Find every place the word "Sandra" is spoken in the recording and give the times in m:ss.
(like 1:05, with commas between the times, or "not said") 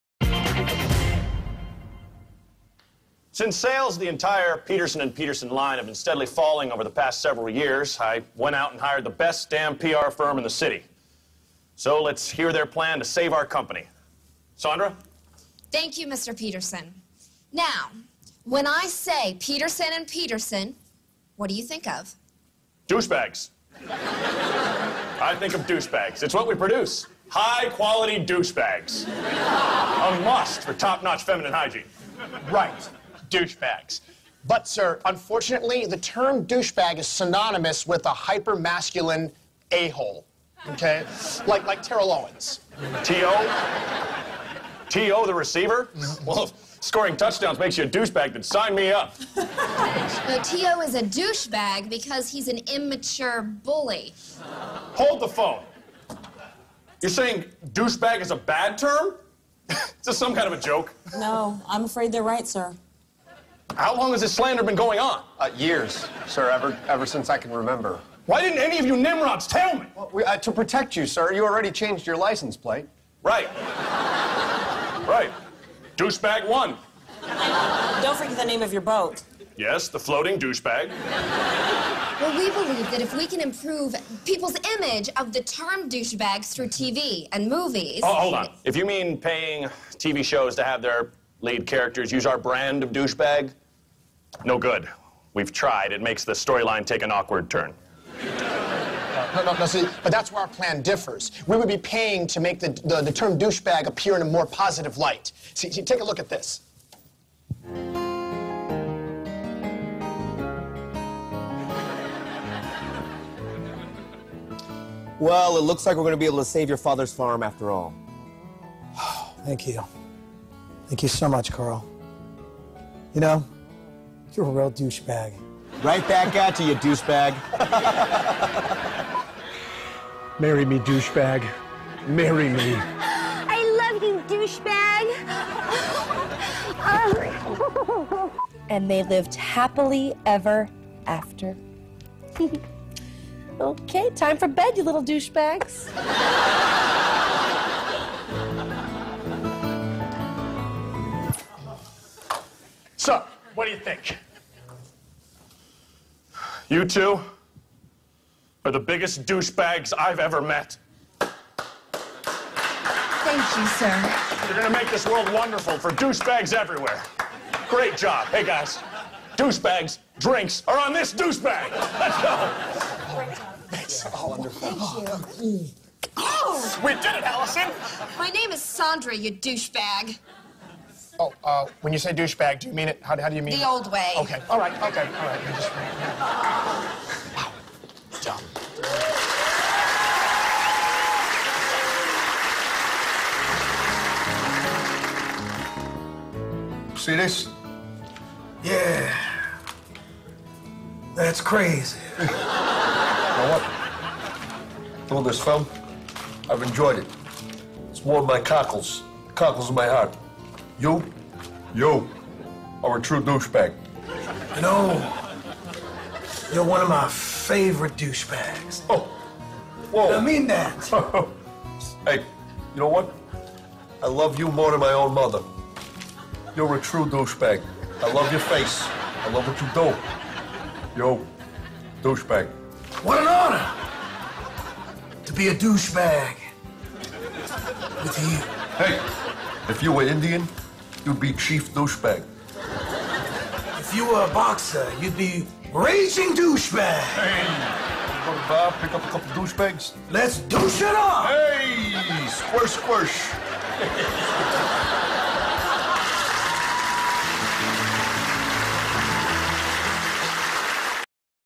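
0:14, 2:58.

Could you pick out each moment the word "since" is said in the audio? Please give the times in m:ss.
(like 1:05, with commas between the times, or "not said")
0:03, 1:07.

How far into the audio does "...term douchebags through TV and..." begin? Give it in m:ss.
1:25.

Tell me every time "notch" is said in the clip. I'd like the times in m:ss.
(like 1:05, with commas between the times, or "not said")
0:30.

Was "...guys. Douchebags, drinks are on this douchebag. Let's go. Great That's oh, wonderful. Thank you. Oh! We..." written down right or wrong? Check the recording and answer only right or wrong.
right.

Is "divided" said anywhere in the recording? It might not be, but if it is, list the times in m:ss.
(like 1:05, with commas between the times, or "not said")
not said.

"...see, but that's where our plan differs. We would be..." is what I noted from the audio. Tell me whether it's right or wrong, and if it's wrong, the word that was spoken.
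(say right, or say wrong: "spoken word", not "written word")
right.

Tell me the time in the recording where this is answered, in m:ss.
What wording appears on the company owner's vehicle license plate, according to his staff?
1:15.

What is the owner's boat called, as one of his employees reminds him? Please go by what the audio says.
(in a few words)
The Floating Douchebag.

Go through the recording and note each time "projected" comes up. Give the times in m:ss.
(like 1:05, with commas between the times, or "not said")
not said.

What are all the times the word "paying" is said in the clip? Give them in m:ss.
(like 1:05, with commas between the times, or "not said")
1:29, 1:41.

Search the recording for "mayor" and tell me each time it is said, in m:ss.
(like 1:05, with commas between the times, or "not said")
not said.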